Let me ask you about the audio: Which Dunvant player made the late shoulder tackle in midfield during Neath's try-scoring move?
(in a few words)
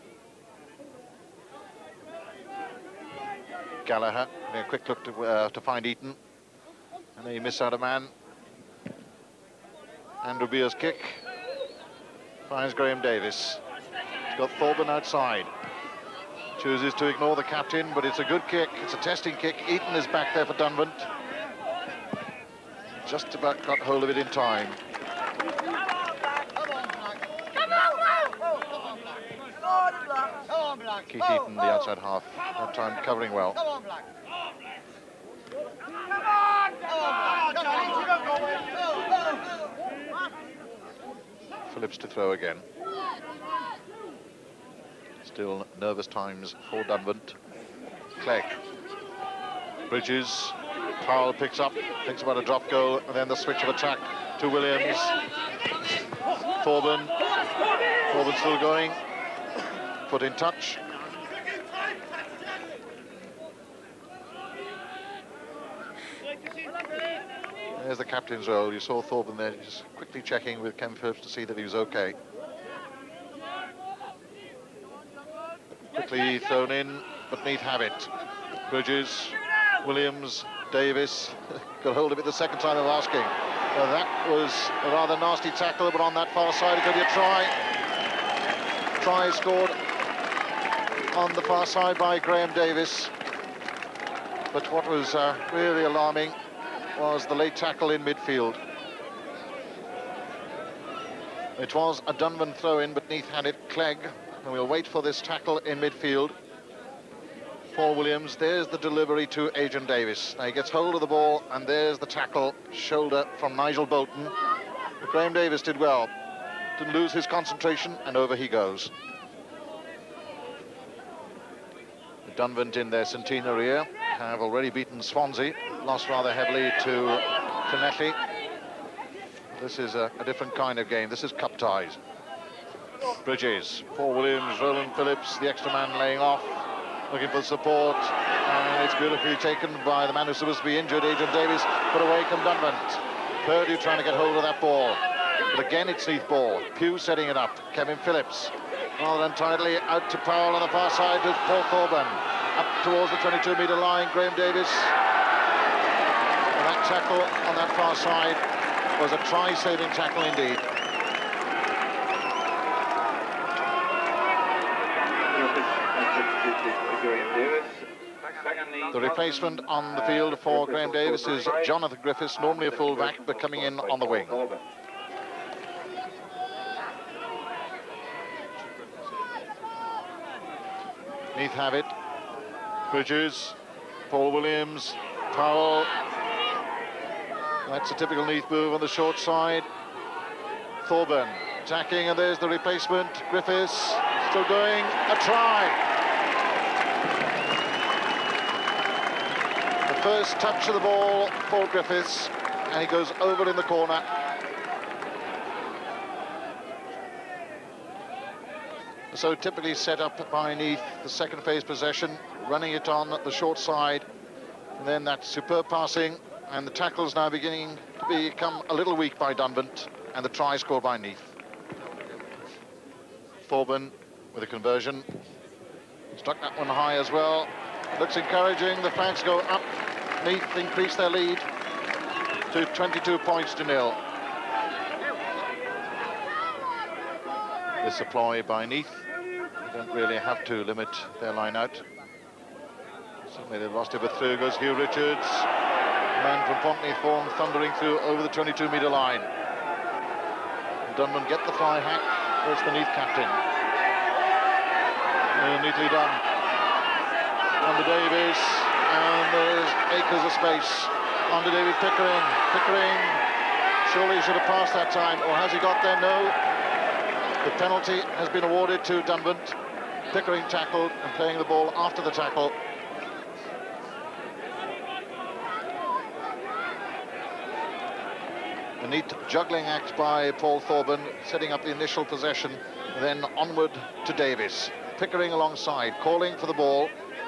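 Nigel Bolton.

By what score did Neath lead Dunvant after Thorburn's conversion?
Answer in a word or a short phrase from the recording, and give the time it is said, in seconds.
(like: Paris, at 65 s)
22 points to nil, at 232 s.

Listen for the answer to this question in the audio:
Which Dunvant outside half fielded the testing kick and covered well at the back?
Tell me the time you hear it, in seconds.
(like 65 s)
31 s.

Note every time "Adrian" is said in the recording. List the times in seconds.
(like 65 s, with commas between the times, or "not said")
109 s, 141 s.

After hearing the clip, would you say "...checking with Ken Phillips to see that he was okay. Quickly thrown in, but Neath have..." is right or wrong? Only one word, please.
right.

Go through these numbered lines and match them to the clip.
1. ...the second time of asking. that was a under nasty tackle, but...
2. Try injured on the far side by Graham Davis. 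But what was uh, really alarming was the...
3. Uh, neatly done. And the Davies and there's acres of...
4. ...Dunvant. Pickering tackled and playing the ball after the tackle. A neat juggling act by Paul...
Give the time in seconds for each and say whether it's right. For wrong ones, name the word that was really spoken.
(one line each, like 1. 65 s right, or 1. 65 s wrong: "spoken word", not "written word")
1. 82 s wrong: "rather", not "under"
2. 89 s wrong: "scored", not "injured"
3. 255 s right
4. 269 s right.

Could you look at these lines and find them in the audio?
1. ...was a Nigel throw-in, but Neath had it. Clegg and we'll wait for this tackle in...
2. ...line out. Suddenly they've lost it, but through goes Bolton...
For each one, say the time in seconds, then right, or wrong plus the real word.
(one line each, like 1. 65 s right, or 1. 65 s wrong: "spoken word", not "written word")
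1. 101 s wrong: "Dunvant", not "Nigel"
2. 241 s wrong: "Hugh", not "Bolton".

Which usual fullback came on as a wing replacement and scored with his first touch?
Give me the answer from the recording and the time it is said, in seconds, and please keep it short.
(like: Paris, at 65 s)
Jonathan Griffiths, at 171 s.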